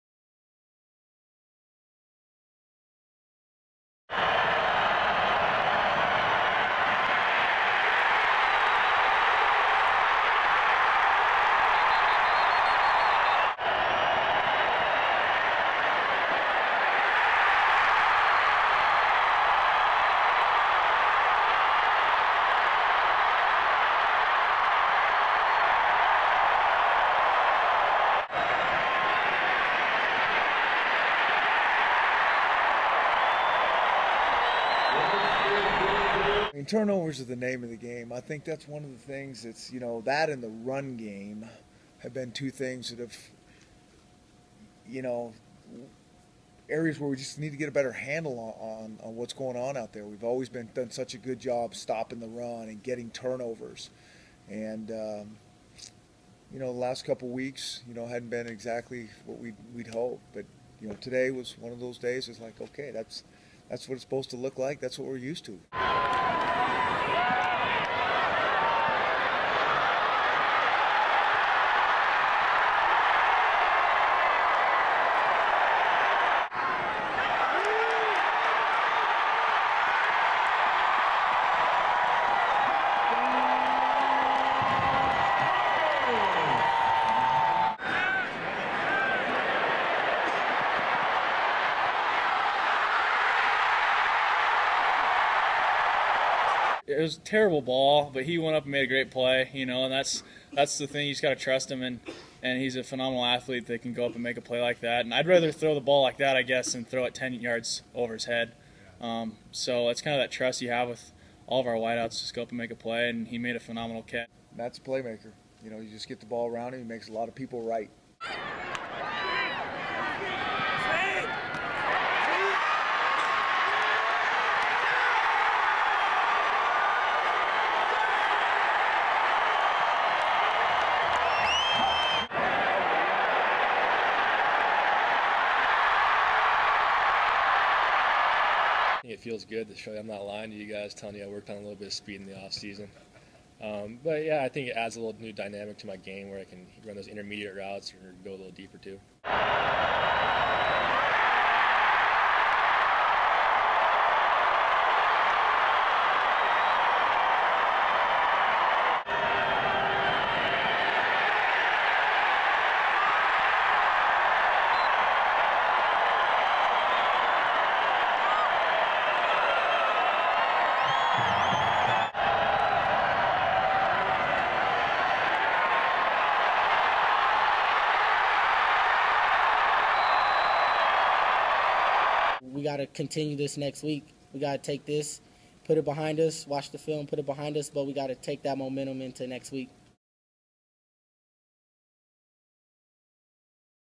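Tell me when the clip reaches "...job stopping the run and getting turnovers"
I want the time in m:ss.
0:51.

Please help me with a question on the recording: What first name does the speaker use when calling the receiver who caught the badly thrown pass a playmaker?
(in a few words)
Matt.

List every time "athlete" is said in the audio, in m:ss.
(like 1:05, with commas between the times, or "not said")
1:43.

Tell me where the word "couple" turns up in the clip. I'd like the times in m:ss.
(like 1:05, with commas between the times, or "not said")
0:57.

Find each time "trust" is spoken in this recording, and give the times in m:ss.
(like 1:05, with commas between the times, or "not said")
1:41, 1:50.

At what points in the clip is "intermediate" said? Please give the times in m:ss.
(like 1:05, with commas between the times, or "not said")
2:27.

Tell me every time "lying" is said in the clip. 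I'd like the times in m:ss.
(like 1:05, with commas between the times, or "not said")
2:20.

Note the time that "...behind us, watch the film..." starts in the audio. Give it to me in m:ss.
3:05.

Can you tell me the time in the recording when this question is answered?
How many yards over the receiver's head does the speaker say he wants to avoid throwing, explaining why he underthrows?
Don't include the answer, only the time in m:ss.
1:47.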